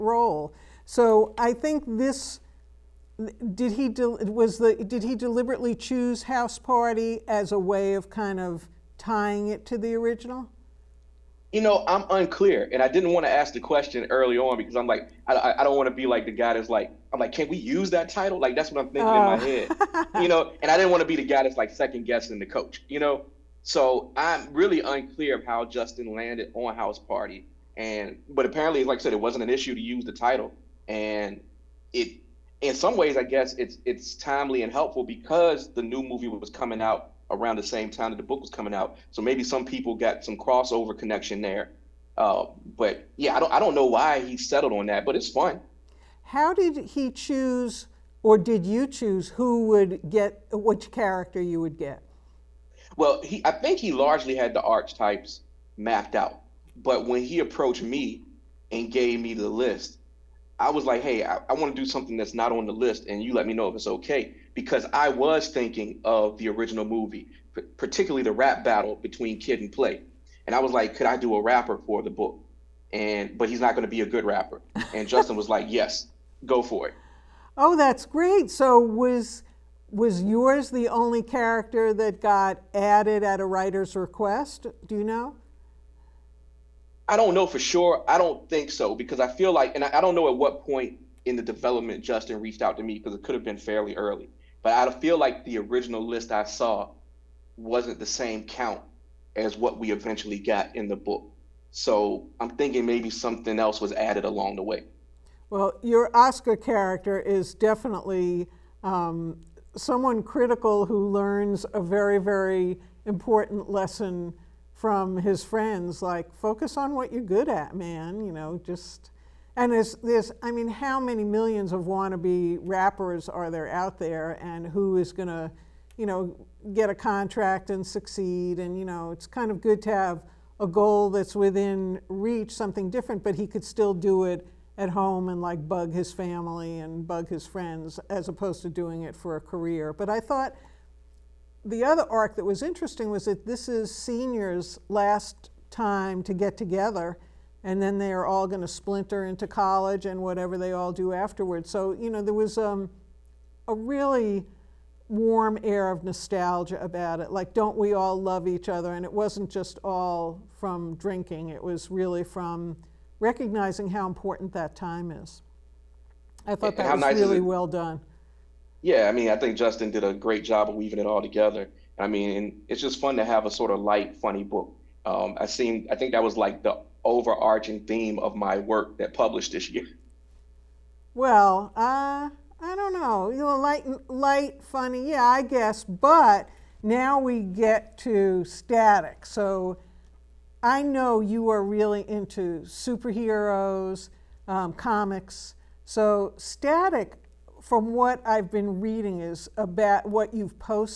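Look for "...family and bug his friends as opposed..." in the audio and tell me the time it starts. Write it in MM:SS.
02:16.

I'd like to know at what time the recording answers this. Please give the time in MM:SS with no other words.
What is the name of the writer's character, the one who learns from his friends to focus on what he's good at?
01:46.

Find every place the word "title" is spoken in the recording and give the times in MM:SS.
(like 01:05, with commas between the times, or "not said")
00:18, 00:30.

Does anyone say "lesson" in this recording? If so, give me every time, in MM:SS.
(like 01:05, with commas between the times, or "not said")
01:53.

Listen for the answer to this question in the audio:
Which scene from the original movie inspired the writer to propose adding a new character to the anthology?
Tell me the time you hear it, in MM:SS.
01:08.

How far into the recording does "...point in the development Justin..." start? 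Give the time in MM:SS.
01:30.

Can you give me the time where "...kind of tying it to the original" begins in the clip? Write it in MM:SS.
00:08.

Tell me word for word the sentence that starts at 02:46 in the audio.
I thought that was nice really well done.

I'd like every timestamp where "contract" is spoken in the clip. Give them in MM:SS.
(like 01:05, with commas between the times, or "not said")
02:06.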